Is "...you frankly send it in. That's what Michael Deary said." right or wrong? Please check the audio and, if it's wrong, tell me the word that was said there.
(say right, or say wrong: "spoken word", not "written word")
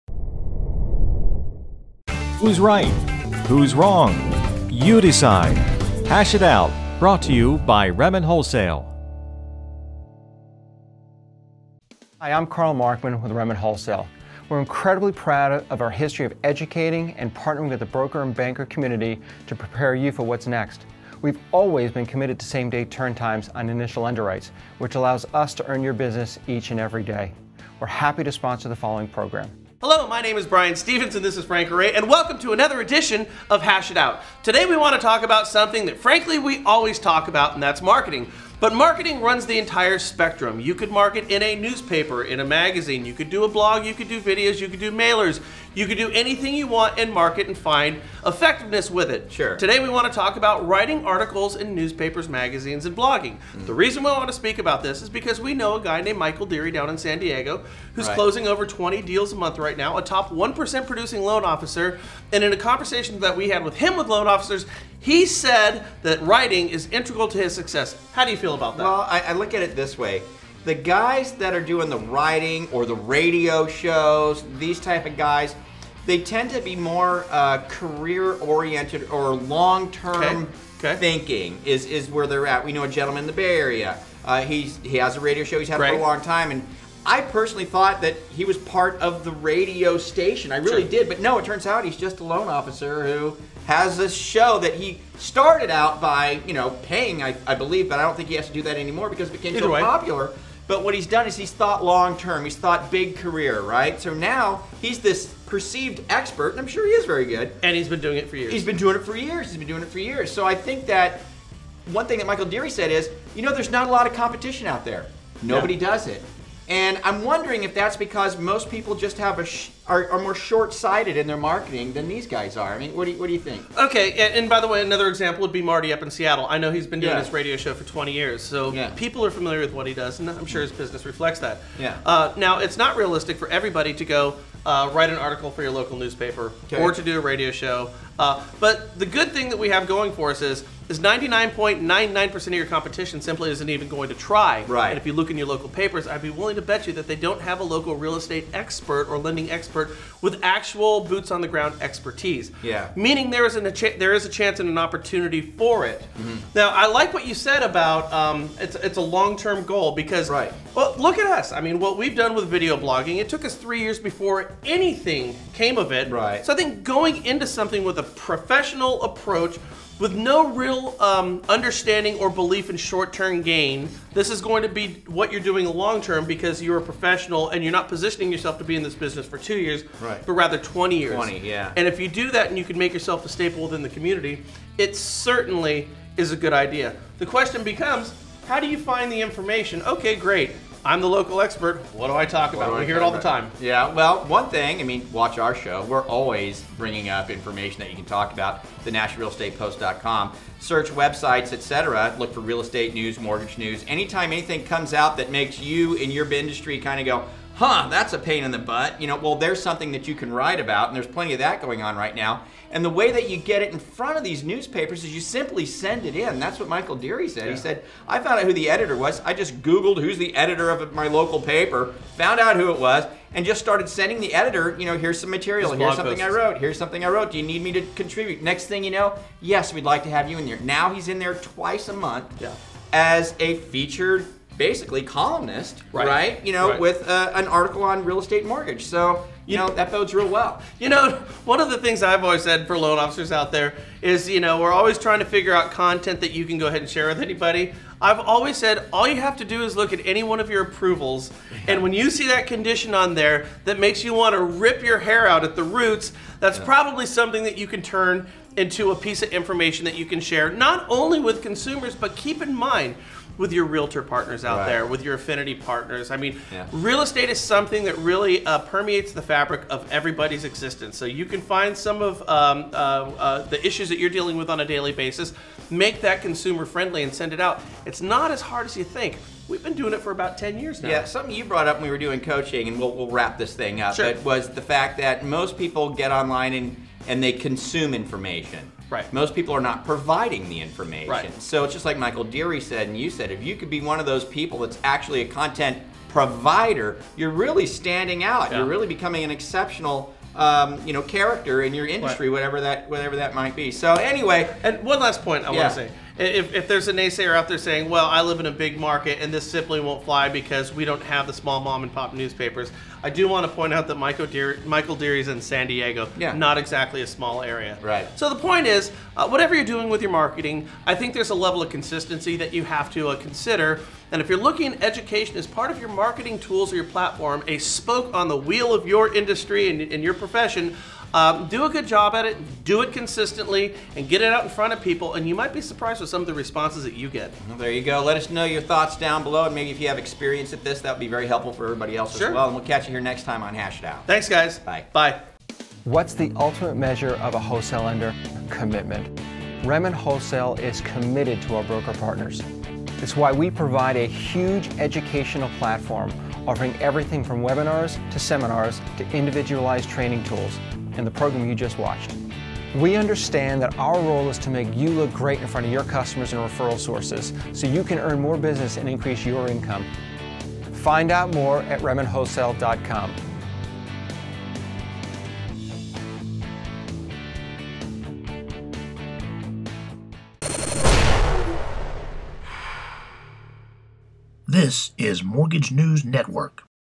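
wrong: "simply", not "frankly".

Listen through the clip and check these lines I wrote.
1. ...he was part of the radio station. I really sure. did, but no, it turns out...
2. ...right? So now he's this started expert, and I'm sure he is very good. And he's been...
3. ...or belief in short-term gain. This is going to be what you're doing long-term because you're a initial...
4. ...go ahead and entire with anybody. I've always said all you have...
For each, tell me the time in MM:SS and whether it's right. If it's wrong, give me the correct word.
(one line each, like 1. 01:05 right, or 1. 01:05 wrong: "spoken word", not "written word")
1. 01:28 right
2. 01:43 wrong: "perceived", not "started"
3. 02:52 wrong: "professional", not "initial"
4. 04:06 wrong: "share", not "entire".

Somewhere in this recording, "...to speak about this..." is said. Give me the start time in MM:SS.
00:54.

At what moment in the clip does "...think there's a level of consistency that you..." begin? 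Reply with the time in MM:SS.
05:20.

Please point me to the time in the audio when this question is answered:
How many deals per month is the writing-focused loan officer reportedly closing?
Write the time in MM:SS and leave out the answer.
00:58.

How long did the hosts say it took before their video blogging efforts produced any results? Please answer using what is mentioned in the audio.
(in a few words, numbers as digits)
3 years.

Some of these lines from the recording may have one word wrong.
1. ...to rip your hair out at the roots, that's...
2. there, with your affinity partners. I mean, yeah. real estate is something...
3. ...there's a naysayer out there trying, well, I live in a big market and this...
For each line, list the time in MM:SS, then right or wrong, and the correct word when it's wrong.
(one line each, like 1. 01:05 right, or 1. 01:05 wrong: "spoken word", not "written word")
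1. 04:14 right
2. 04:24 right
3. 05:06 wrong: "saying", not "trying".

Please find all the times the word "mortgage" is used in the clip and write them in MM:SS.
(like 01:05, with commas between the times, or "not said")
03:23, 03:58, 06:25.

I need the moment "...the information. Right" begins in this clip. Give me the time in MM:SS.
04:50.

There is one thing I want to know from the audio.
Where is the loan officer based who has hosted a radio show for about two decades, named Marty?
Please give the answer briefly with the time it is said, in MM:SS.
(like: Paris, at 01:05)
Seattle, at 02:06.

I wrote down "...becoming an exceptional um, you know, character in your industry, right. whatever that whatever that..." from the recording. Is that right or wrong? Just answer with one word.
right.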